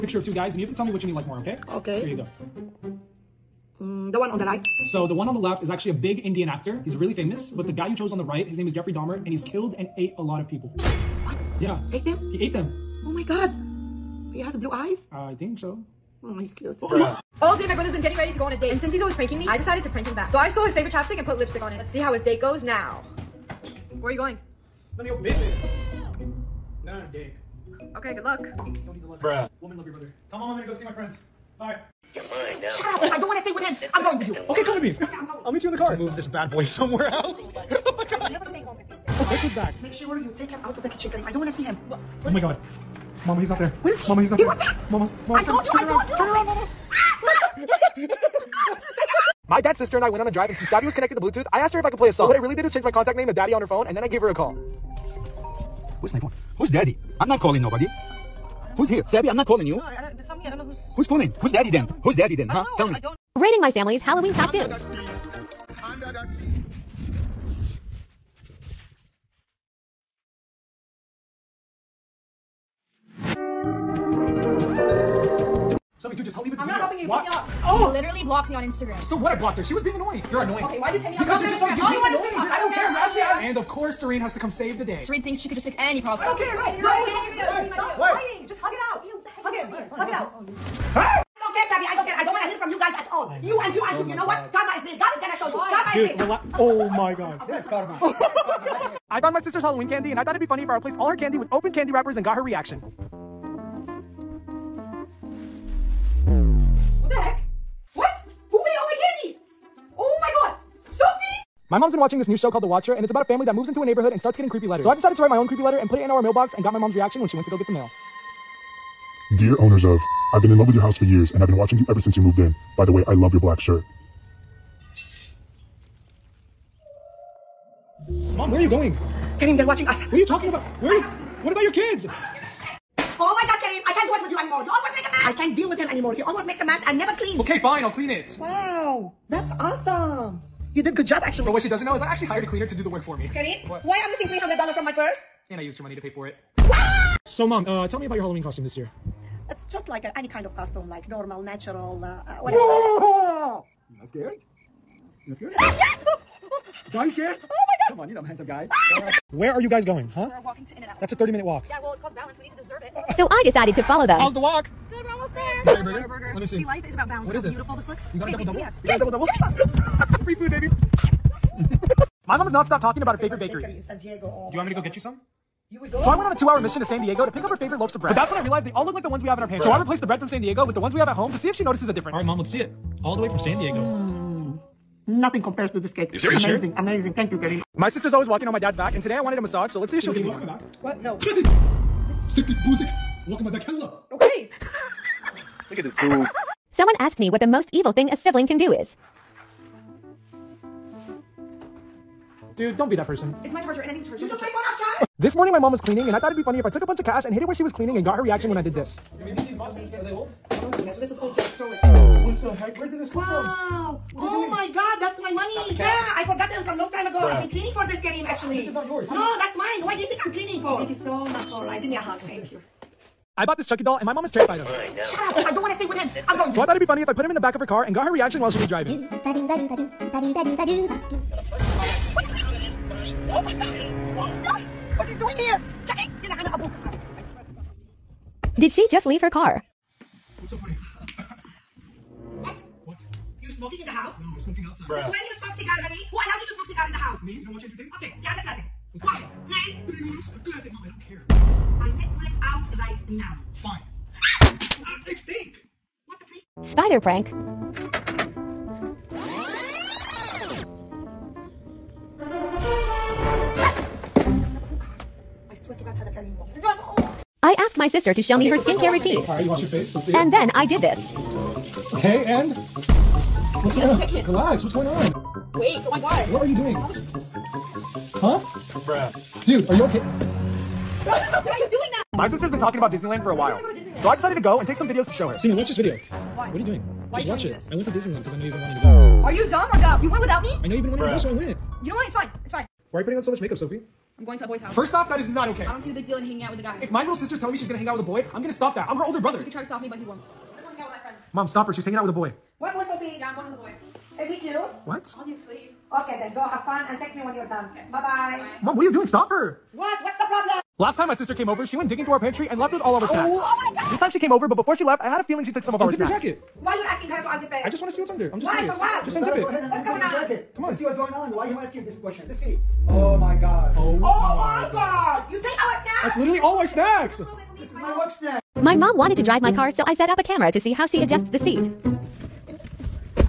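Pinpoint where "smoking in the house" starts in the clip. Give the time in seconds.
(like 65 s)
243 s.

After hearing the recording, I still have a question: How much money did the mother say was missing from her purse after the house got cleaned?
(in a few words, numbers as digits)
$300.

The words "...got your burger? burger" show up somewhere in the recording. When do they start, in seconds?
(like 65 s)
165 s.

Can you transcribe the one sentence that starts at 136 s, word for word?
He always makes a mess and never cleans.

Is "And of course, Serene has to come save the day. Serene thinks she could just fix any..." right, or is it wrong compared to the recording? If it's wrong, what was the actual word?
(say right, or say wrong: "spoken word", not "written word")
right.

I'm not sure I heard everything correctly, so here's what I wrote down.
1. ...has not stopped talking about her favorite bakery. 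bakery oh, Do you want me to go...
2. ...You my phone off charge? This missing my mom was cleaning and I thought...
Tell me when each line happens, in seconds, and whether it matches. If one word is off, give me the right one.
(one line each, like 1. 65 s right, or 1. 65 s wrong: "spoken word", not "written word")
1. 172 s right
2. 204 s wrong: "morning", not "missing".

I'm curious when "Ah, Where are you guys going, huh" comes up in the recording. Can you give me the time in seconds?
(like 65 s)
158 s.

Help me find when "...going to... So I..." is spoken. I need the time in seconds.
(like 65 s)
226 s.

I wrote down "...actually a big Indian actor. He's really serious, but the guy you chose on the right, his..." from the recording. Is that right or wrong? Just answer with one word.
wrong.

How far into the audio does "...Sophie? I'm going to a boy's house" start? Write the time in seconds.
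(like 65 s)
293 s.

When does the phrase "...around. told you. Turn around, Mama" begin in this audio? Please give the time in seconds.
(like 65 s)
45 s.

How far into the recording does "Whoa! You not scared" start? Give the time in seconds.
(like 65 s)
152 s.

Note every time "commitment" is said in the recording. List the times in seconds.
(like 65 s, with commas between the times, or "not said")
not said.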